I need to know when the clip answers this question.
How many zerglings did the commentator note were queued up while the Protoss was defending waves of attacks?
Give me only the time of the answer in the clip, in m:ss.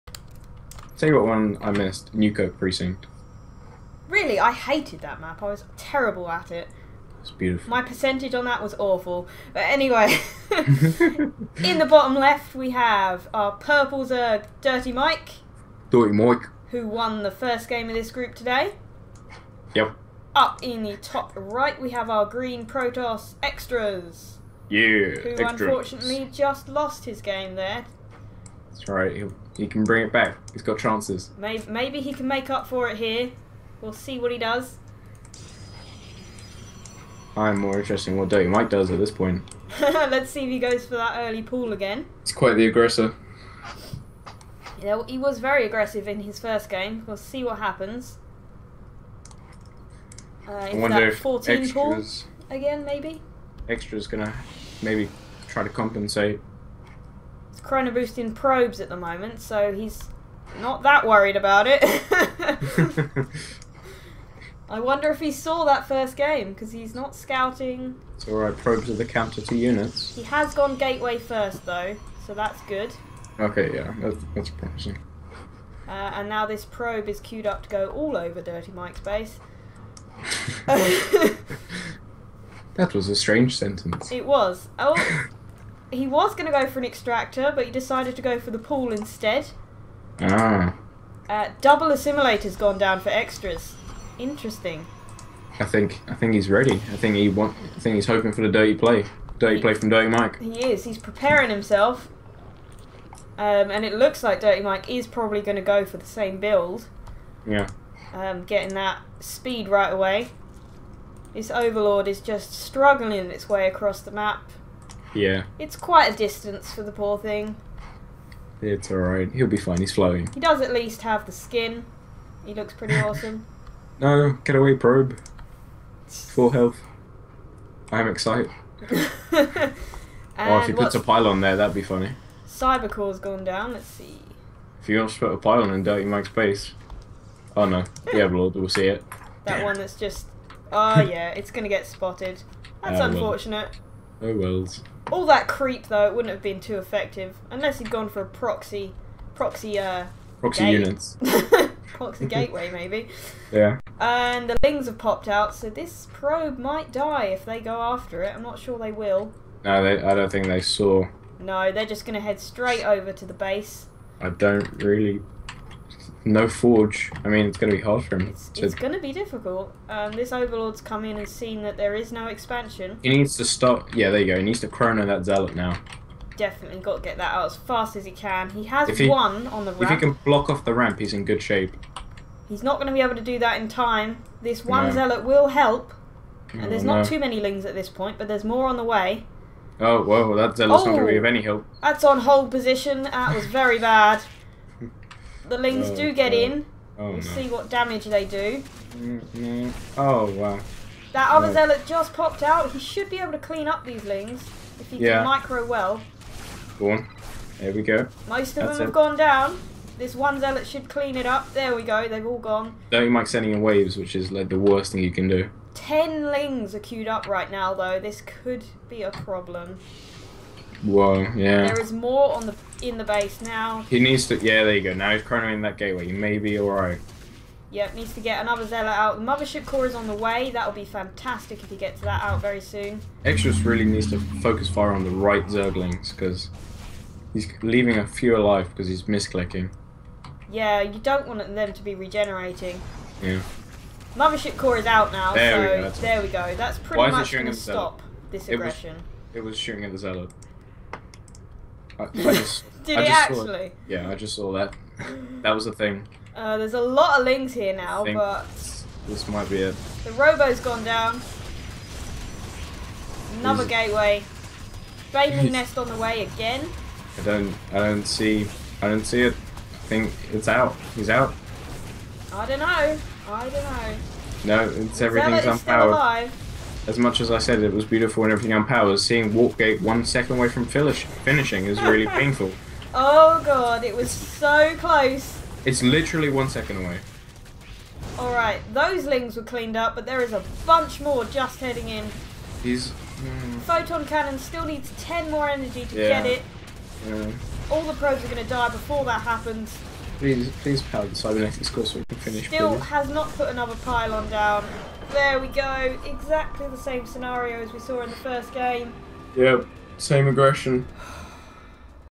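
3:35.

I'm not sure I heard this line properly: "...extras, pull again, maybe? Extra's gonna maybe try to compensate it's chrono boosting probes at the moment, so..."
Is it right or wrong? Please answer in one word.
right.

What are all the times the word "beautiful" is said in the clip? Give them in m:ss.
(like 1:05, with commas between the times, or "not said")
0:07, 4:37.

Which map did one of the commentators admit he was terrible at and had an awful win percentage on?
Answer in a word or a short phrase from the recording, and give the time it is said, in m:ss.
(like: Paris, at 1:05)
Newkirk Precinct, at 0:02.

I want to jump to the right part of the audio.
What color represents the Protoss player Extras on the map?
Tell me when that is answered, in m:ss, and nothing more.
0:22.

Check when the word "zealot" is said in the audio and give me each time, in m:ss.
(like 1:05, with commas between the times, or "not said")
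2:55, 3:04, 3:10, 3:21, 3:30, 3:48, 4:09.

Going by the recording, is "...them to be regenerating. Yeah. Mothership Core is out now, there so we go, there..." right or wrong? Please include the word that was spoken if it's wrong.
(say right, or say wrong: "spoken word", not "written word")
right.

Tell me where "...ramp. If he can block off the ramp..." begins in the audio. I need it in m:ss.
2:59.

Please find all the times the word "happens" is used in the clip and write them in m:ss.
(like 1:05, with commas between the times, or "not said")
0:47, 4:59.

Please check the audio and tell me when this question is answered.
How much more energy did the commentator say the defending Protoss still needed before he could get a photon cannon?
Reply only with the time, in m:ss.
4:55.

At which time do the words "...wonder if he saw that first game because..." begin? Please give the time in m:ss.
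1:04.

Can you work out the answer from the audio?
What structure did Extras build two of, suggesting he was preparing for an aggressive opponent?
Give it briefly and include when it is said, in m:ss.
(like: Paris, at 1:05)
Assimilator, at 1:31.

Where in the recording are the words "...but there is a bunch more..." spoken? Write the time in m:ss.
4:49.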